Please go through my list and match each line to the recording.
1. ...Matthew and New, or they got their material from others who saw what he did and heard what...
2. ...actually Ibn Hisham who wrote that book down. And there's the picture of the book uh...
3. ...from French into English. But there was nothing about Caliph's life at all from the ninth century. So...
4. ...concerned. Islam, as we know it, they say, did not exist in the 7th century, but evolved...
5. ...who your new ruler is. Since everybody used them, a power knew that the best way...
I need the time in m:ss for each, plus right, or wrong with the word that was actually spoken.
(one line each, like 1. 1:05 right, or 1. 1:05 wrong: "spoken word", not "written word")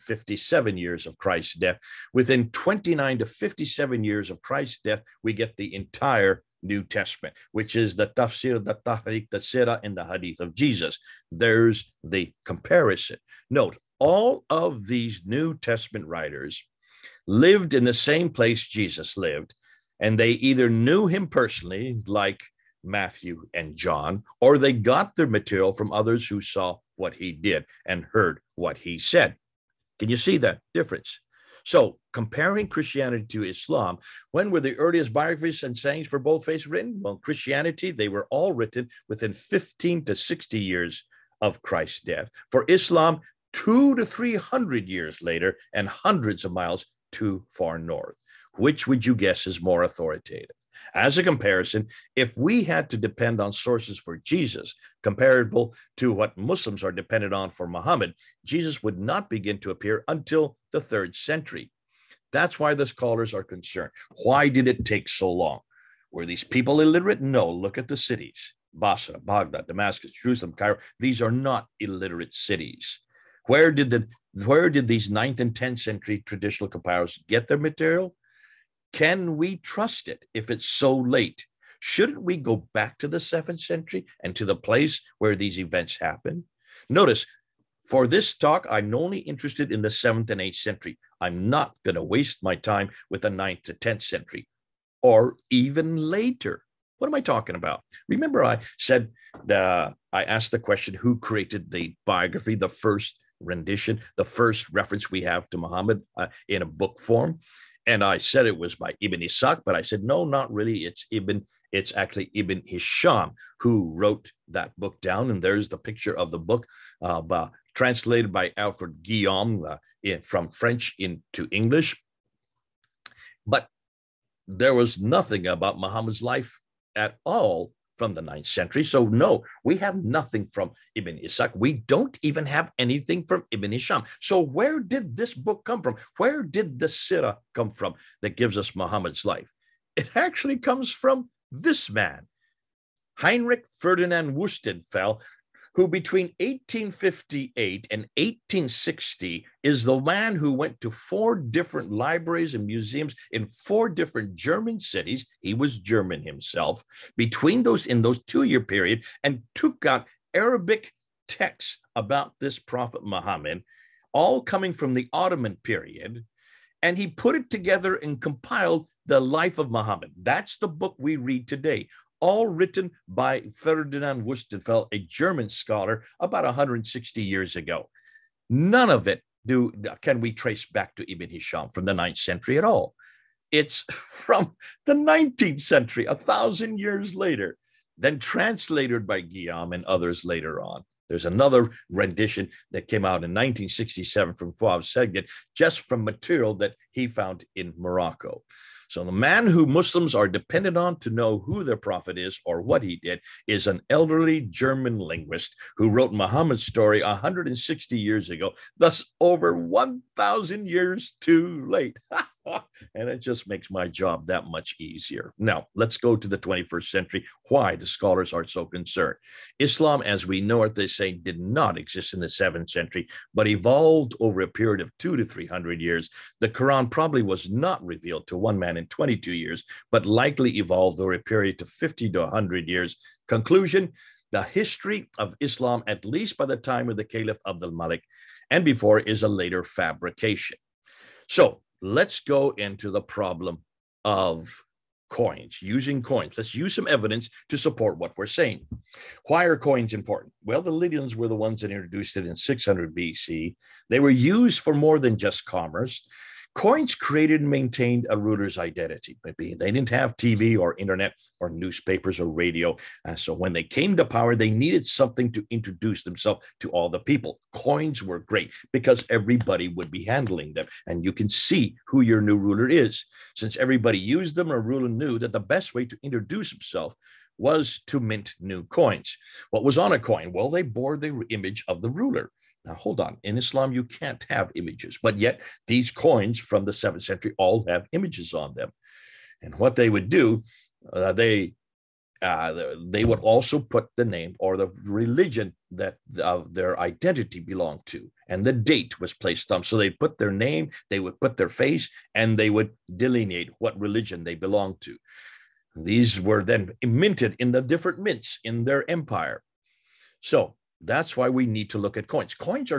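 1. 0:22 wrong: "John", not "New"
2. 1:51 right
3. 2:00 wrong: "Muhammad", not "Caliph"
4. 3:38 right
5. 4:31 wrong: "ruler", not "power".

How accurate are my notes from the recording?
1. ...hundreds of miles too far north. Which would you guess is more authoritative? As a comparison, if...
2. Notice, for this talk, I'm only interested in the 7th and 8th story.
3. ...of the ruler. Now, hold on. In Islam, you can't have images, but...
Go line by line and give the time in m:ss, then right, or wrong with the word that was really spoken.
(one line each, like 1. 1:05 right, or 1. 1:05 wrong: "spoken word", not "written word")
1. 0:45 right
2. 1:26 wrong: "century", not "story"
3. 4:41 right.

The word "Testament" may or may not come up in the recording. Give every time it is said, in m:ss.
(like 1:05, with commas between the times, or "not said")
0:06, 0:15.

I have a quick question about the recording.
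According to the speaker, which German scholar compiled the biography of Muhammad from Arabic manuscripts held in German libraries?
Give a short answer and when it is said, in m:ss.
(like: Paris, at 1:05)
Heinrich Ferdinand Wustenfeld, at 2:23.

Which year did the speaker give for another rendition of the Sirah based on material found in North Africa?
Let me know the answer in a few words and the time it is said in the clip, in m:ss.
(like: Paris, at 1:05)
1967, at 3:13.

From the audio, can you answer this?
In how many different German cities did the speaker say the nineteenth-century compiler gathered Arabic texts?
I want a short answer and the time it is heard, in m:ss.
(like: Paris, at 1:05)
4, at 2:33.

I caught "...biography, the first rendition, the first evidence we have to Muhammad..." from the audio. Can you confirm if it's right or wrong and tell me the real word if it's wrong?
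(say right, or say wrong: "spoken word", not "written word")
wrong: "reference", not "evidence".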